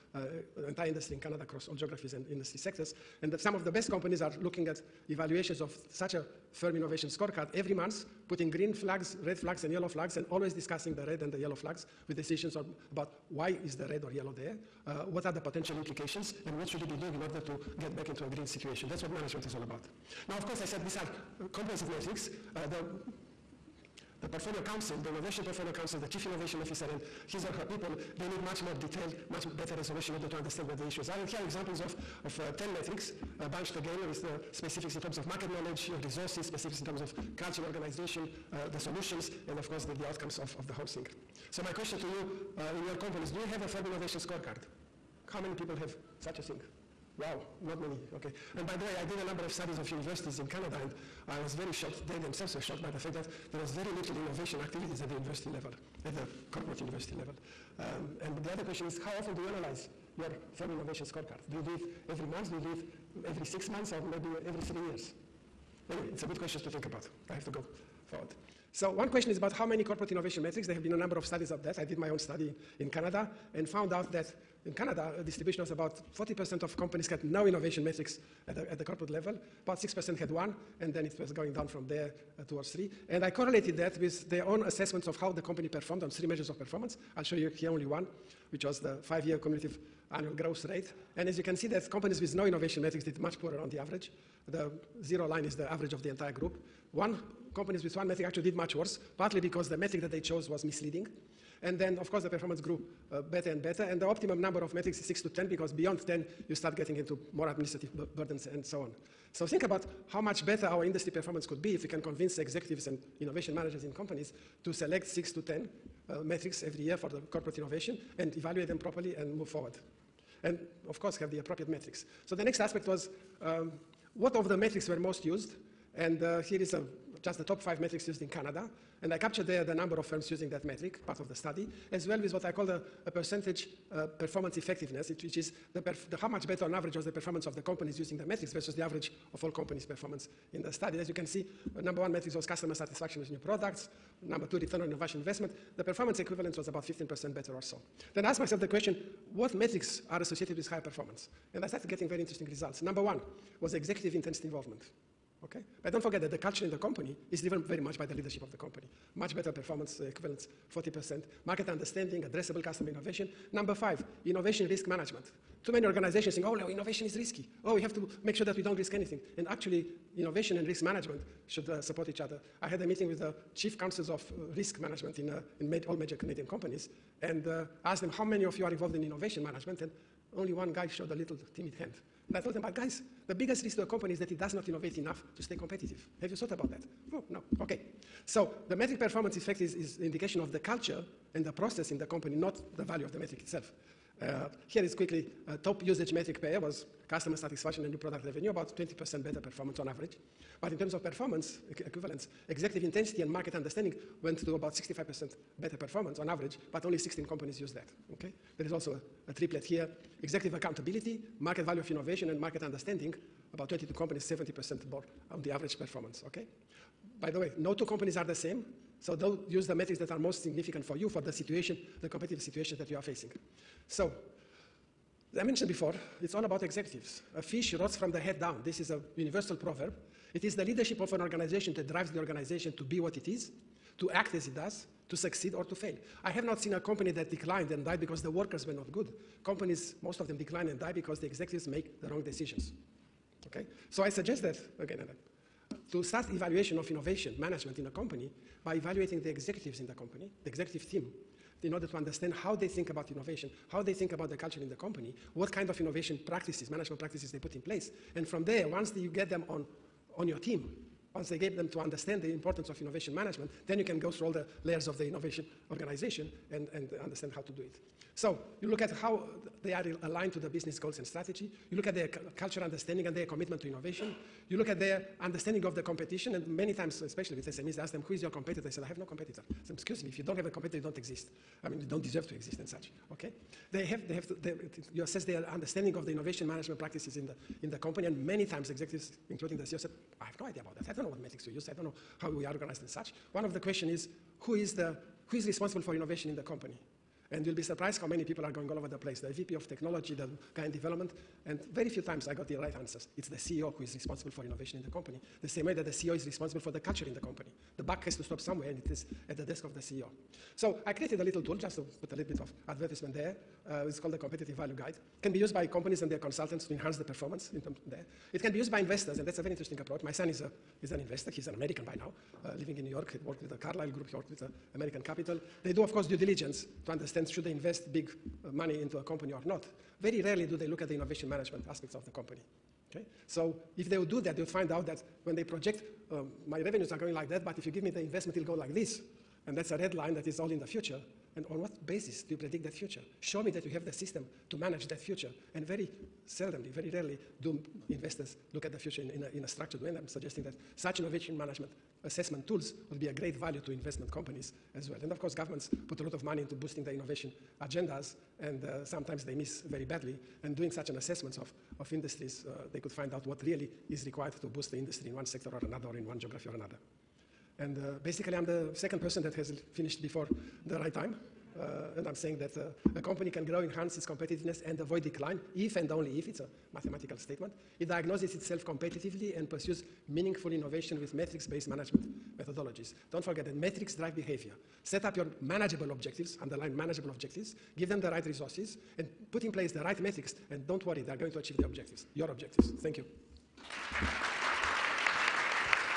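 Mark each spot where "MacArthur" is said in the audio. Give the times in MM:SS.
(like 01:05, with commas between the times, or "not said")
not said.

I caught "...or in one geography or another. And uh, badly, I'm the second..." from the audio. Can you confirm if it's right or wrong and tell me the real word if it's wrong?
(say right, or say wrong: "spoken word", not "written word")
wrong: "basically", not "badly".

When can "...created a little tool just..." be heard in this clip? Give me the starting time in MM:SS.
05:10.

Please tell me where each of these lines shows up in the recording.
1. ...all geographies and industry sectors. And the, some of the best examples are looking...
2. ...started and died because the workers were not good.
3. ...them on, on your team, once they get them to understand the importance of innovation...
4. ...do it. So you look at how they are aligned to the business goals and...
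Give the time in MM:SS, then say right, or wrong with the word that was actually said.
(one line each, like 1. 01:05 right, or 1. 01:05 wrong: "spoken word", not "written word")
1. 00:01 wrong: "companies", not "examples"
2. 03:57 wrong: "declined", not "started"
3. 04:19 right
4. 04:27 right.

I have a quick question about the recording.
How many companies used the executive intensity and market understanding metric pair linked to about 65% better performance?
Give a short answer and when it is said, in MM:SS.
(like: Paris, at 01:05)
16, at 03:26.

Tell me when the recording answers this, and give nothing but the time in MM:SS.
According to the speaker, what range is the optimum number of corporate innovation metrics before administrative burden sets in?
01:45.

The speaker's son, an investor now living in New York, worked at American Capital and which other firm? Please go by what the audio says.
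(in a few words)
Carlyle Group.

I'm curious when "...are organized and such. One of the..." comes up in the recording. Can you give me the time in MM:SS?
04:52.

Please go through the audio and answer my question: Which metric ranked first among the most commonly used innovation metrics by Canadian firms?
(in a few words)
customer satisfaction with new products.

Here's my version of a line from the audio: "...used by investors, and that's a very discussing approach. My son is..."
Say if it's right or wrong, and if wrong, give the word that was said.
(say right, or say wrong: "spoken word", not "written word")
wrong: "interesting", not "discussing".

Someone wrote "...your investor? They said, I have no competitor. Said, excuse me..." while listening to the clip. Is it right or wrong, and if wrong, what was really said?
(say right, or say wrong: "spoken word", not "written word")
wrong: "competitor", not "investor".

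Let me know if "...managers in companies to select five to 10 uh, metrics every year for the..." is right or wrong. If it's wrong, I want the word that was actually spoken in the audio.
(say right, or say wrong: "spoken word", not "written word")
wrong: "six", not "five".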